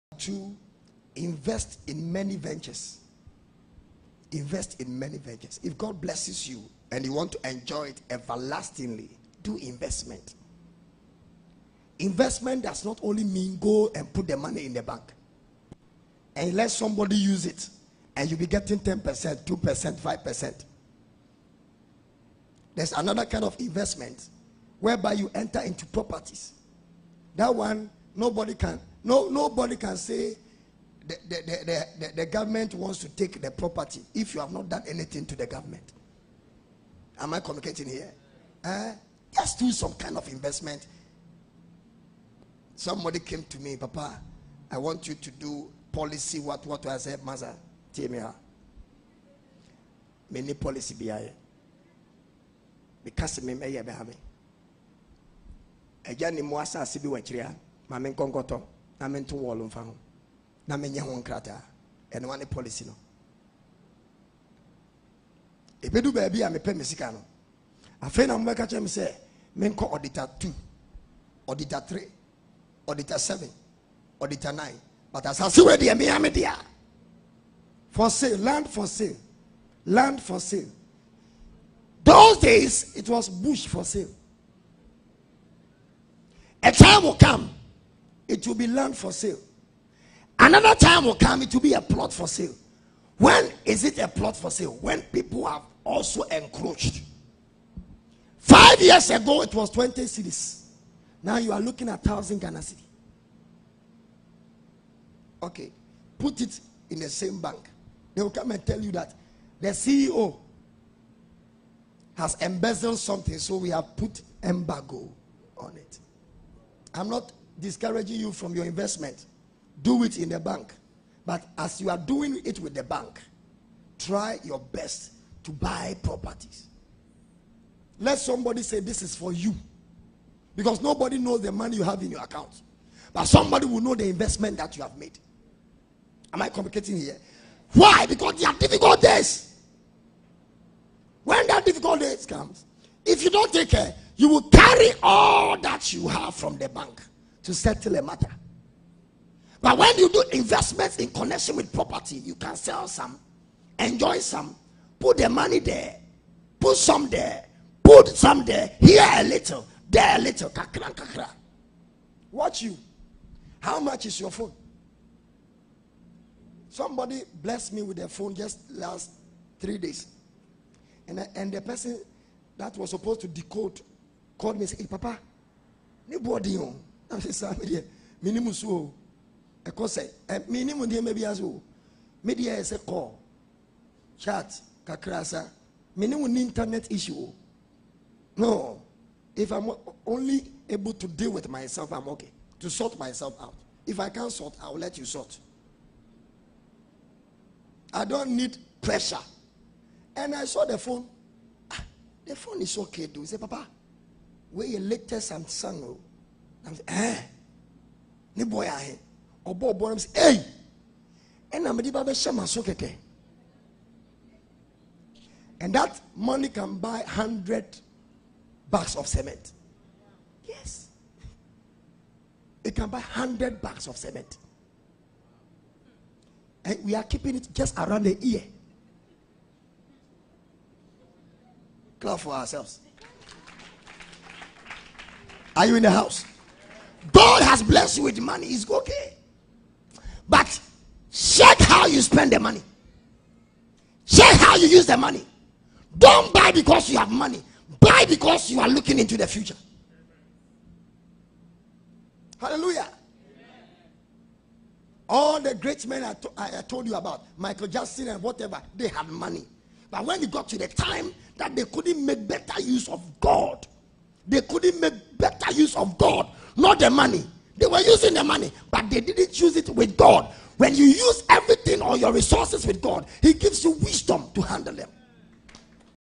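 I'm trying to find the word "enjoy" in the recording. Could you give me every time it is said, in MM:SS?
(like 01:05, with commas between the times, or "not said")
00:07, 02:33.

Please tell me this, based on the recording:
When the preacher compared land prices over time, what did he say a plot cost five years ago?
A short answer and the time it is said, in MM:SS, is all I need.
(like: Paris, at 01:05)
20 cedis, at 01:39.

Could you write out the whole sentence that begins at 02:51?
And, I, and the person that was supposed to decode called me and said, Hey, Papa, nobody on?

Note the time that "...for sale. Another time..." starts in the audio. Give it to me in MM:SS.
01:28.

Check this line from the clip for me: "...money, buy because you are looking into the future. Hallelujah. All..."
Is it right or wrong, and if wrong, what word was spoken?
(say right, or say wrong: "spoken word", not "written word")
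right.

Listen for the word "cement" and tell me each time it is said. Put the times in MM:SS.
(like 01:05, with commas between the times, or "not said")
03:39, 03:43.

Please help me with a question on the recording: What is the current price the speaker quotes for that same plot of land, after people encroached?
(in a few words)
1,000 Ghana cedi.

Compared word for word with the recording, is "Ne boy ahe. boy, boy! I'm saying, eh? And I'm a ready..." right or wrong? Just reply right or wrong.
right.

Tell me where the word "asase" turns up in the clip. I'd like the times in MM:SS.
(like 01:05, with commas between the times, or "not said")
00:56, 01:15.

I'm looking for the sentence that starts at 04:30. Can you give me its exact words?
When you use everything or your resources with God, He gives you wisdom to handle them.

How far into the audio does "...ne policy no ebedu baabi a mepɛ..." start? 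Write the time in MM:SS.
01:02.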